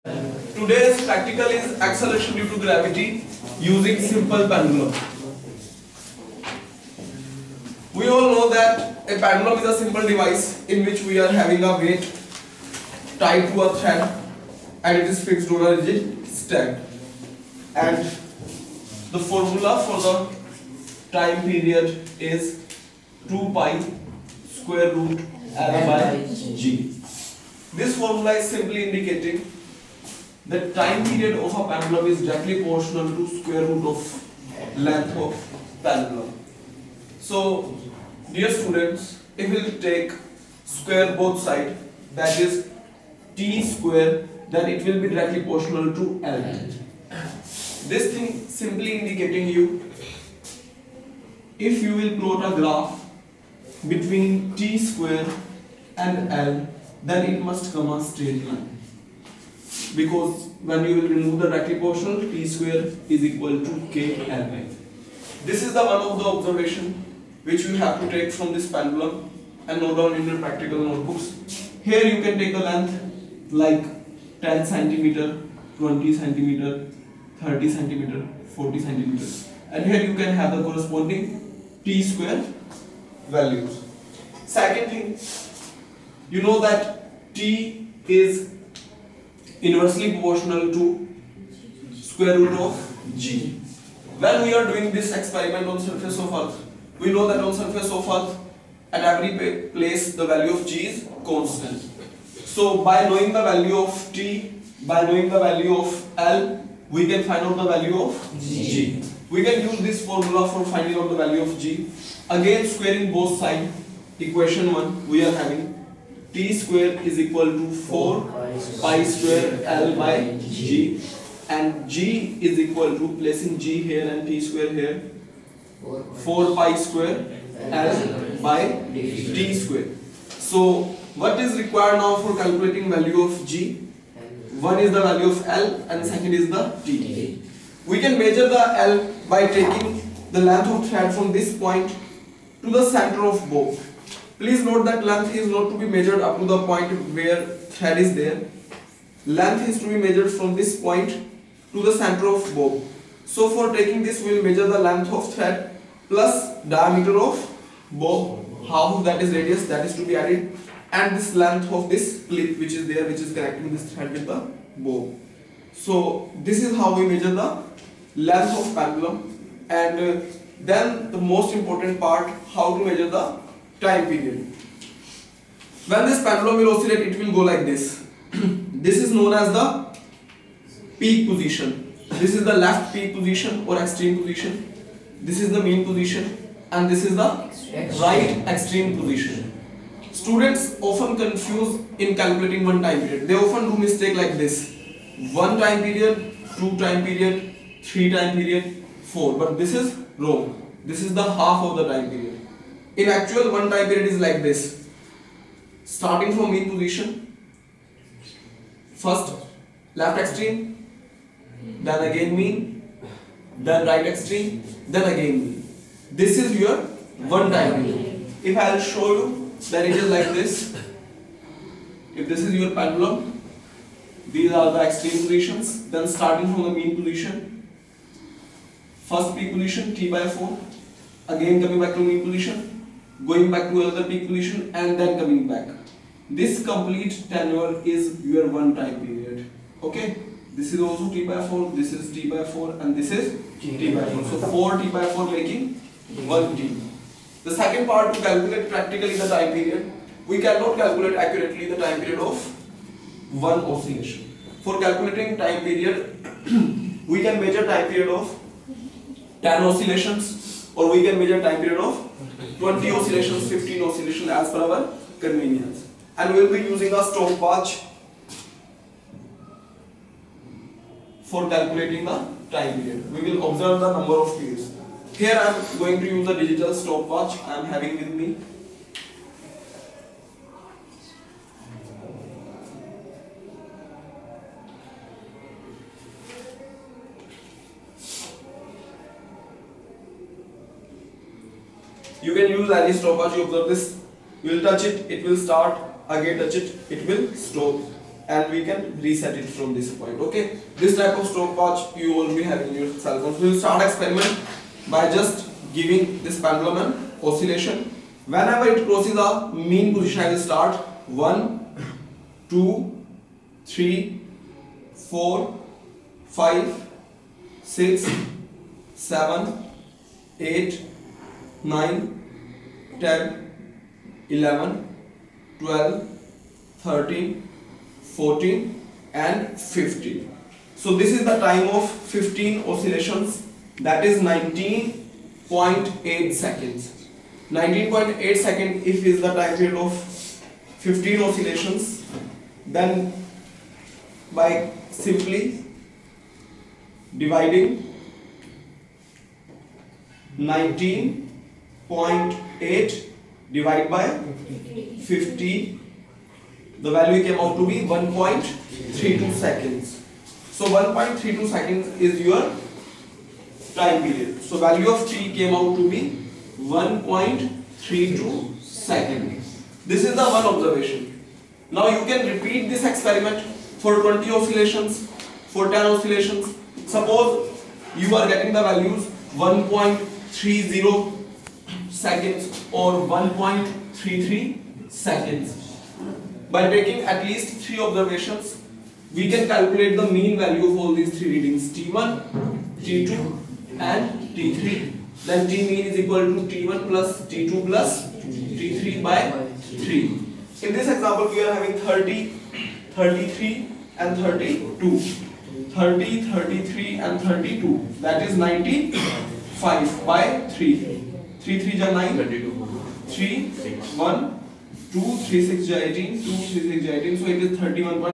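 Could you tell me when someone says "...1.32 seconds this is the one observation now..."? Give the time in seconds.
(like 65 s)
366 s.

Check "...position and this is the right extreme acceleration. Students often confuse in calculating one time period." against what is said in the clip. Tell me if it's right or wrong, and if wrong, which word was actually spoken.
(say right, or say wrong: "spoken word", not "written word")
wrong: "position", not "acceleration".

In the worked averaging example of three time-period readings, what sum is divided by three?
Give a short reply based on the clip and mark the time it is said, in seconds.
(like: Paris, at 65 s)
95, at 408 s.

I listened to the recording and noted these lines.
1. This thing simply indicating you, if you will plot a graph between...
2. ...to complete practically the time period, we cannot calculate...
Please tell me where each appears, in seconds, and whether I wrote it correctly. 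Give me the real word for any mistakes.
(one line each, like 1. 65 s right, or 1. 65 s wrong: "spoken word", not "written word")
1. 47 s right
2. 248 s wrong: "calculate", not "complete".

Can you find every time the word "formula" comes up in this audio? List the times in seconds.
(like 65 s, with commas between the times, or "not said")
19 s, 27 s, 110 s.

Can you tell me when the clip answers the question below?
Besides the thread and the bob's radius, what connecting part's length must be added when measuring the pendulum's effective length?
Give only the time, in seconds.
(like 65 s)
162 s.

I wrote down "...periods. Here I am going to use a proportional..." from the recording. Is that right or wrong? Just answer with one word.
wrong.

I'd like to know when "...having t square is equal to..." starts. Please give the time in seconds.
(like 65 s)
115 s.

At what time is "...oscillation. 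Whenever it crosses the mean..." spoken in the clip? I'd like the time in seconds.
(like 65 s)
307 s.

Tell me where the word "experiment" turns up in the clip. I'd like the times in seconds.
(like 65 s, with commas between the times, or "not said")
95 s, 303 s, 372 s.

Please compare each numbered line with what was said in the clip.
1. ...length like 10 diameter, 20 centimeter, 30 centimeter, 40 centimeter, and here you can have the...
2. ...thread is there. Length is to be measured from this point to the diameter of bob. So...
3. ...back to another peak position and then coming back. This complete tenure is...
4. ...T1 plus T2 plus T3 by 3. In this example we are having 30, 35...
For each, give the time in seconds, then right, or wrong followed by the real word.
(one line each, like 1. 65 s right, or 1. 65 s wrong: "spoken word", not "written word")
1. 72 s wrong: "centimeter", not "diameter"
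2. 147 s wrong: "center", not "diameter"
3. 233 s right
4. 396 s wrong: "33", not "35".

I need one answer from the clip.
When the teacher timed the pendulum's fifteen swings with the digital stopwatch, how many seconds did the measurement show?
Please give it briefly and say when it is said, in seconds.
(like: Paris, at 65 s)
19.8 seconds, at 334 s.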